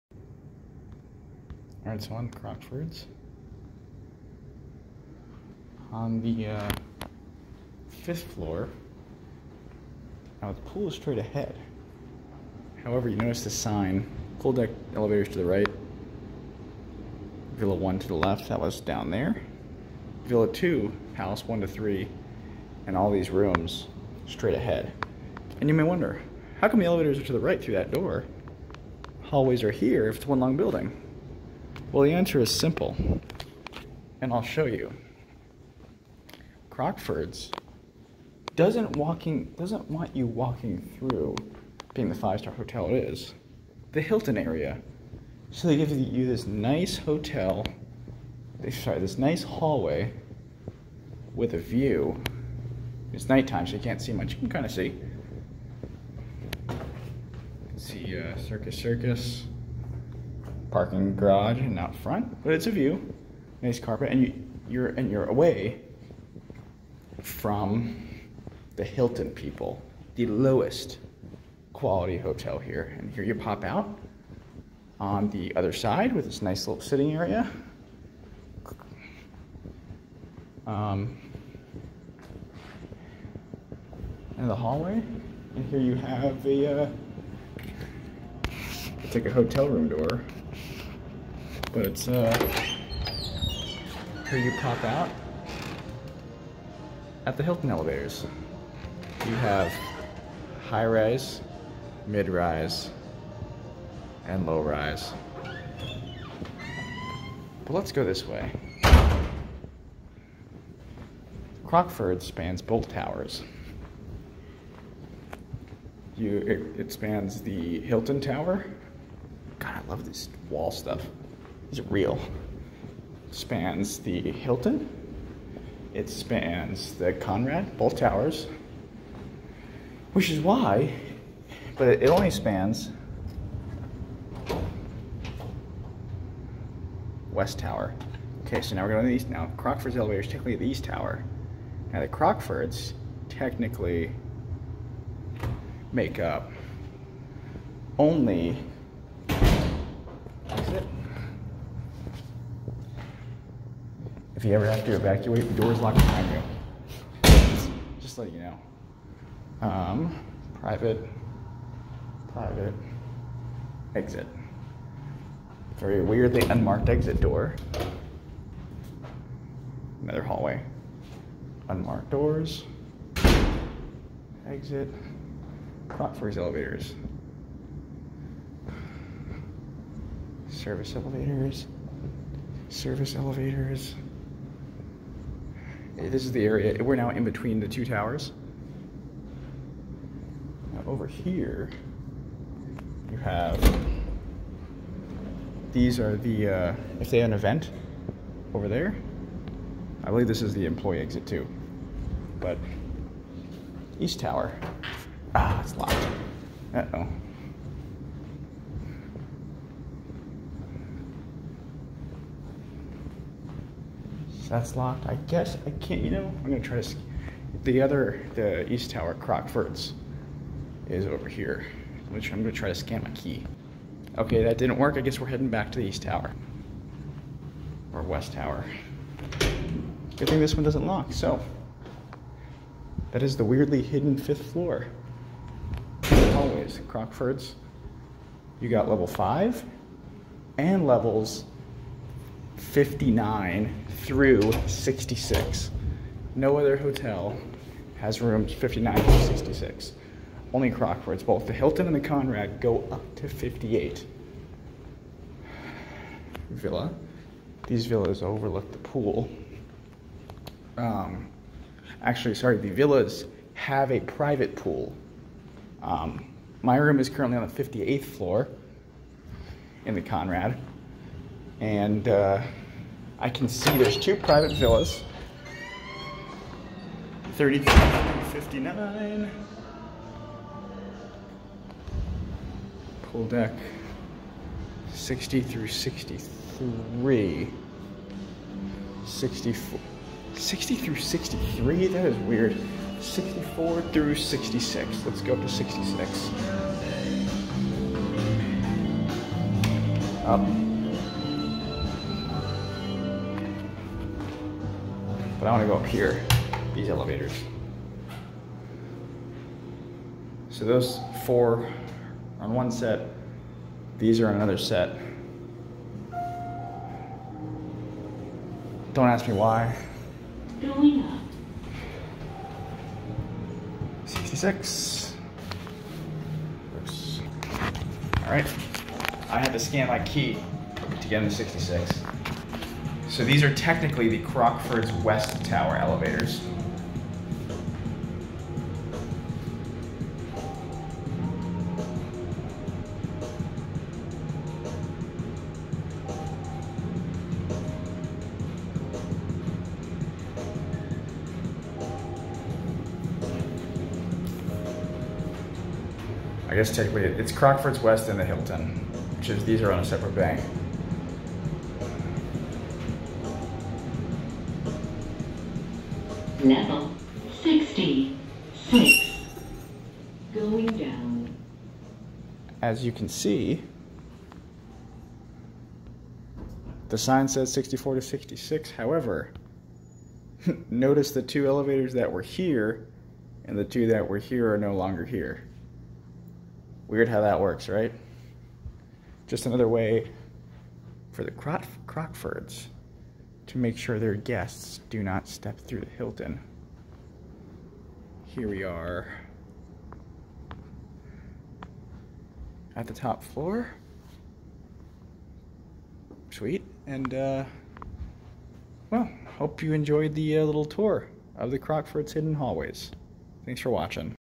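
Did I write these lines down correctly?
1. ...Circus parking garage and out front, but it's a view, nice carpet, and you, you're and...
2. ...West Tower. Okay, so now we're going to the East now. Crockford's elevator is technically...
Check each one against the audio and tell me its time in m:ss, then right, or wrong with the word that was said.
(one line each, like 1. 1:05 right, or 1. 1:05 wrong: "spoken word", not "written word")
1. 0:58 right
2. 2:17 right.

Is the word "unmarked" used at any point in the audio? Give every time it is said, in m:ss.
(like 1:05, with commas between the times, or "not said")
2:46, 2:51.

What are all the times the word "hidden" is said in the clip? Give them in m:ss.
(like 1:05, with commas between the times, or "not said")
3:53, 6:52.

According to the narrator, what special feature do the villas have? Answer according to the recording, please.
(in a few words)
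a private pool.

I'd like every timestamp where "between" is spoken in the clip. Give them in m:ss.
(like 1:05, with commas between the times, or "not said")
3:07.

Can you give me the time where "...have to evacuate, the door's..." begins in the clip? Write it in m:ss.
2:34.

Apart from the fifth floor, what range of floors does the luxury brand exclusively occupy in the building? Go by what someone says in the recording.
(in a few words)
59 through 66.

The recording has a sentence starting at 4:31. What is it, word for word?
And uh, I can see there's two private villas.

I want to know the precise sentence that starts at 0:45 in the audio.
So they give you this nice hotel, they sorry, this nice hallway with a view.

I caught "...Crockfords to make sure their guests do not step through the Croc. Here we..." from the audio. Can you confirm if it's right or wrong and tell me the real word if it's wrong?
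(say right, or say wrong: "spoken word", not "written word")
wrong: "Hilton", not "Croc".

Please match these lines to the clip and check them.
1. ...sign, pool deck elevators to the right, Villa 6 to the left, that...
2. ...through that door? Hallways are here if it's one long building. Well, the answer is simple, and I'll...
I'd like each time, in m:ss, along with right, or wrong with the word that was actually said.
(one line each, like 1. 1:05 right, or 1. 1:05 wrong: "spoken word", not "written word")
1. 0:13 wrong: "1", not "6"
2. 0:27 right.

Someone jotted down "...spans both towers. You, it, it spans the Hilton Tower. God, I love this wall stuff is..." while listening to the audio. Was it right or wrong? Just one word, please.
right.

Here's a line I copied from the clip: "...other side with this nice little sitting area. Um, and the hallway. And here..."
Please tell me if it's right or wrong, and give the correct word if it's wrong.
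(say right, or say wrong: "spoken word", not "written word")
right.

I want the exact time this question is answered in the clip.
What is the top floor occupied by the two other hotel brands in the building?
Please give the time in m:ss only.
4:12.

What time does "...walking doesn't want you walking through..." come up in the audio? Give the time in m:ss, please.
0:38.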